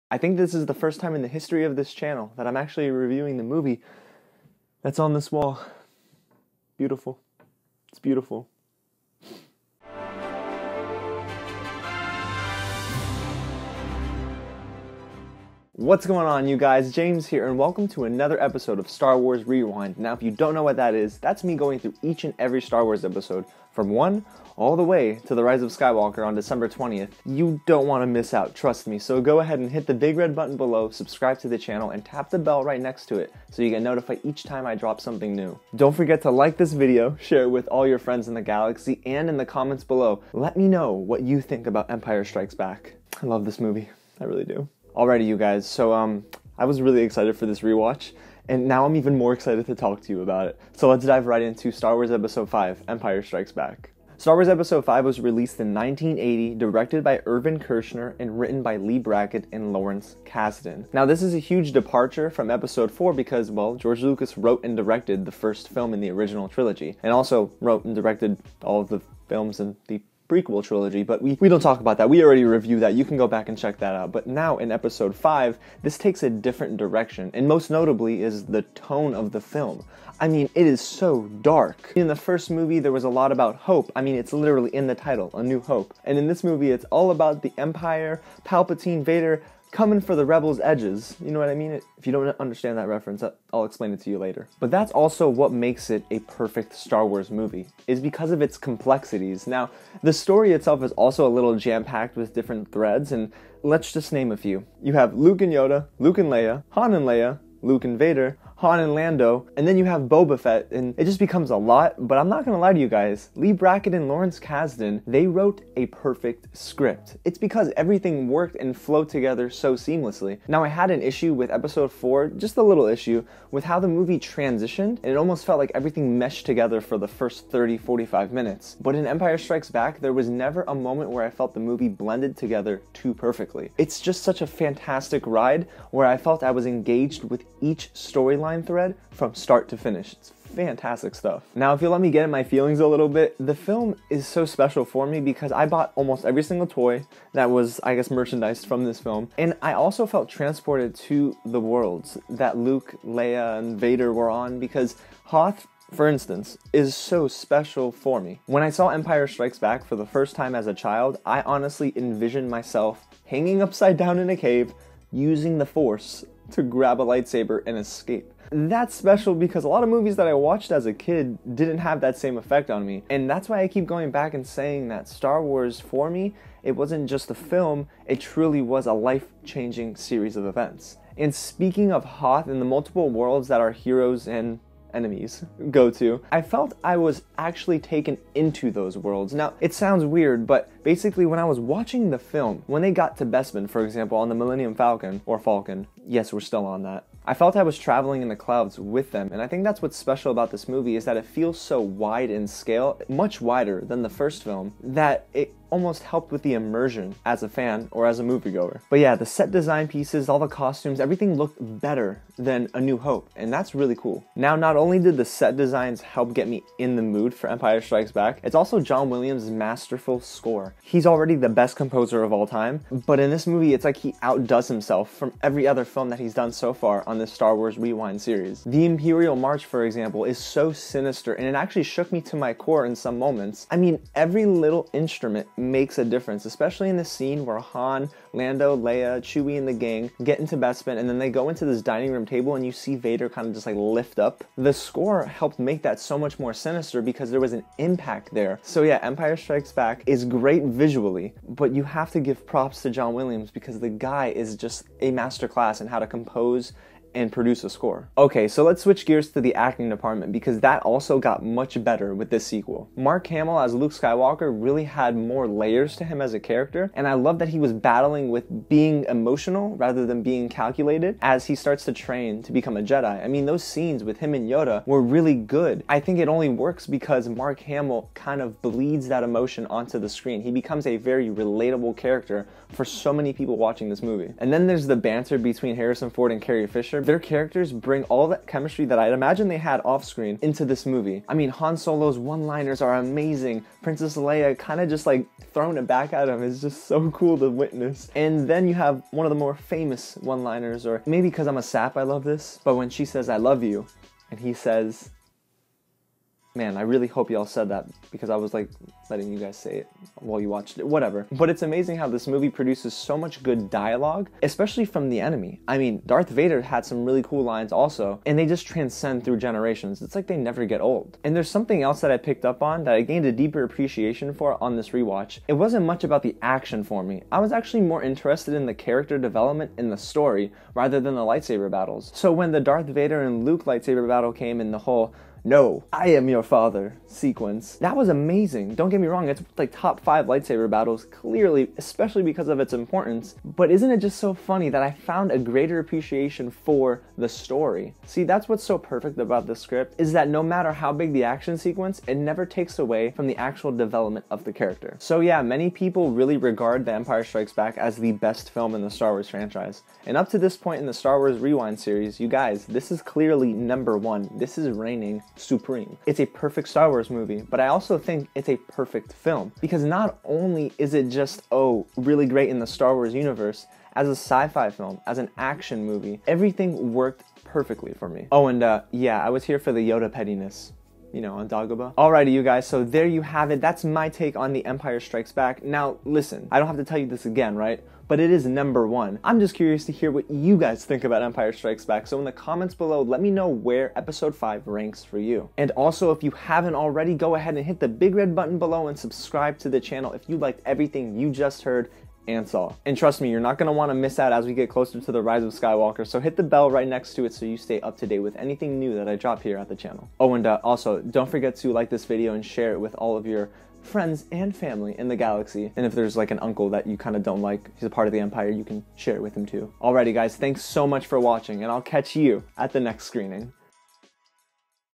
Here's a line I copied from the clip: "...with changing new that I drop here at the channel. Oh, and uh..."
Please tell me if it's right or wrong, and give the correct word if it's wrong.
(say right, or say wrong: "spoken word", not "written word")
wrong: "anything", not "changing".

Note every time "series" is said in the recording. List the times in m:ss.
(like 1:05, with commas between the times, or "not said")
2:59, 3:48, 6:01.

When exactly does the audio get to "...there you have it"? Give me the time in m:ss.
6:22.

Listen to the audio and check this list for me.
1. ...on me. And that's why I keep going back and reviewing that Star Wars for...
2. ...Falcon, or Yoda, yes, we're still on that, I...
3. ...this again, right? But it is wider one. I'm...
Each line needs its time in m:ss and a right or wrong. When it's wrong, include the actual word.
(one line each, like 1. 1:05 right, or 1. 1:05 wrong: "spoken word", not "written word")
1. 2:52 wrong: "saying", not "reviewing"
2. 3:14 wrong: "Falcon", not "Yoda"
3. 6:27 wrong: "number", not "wider".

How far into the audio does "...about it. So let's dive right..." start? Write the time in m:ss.
0:50.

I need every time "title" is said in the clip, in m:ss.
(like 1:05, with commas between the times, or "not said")
1:24.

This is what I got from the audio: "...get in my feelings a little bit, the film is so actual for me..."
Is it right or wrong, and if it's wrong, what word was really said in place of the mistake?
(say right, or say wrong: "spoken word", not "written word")
wrong: "special", not "actual".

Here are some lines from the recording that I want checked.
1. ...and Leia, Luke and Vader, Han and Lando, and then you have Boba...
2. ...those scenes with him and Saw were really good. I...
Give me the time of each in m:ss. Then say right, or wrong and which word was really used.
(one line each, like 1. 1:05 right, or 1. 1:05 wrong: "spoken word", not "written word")
1. 1:46 right
2. 4:33 wrong: "Yoda", not "Saw".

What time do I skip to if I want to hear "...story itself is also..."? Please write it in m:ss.
1:40.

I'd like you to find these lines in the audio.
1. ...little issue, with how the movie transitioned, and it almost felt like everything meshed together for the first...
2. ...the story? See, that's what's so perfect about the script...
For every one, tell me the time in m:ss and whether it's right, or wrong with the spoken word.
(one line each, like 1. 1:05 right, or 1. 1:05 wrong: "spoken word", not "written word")
1. 2:02 right
2. 5:47 right.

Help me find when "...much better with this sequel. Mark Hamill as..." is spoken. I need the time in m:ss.
4:21.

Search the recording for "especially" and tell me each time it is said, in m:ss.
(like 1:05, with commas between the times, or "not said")
3:56, 5:14, 5:41.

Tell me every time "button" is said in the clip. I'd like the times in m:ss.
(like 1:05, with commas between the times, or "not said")
0:30, 6:38.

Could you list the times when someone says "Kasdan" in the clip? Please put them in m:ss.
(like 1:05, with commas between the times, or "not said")
1:00, 1:54.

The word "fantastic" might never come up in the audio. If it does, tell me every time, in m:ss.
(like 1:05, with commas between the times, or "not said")
2:14, 2:20.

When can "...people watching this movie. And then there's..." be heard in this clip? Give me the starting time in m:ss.
4:43.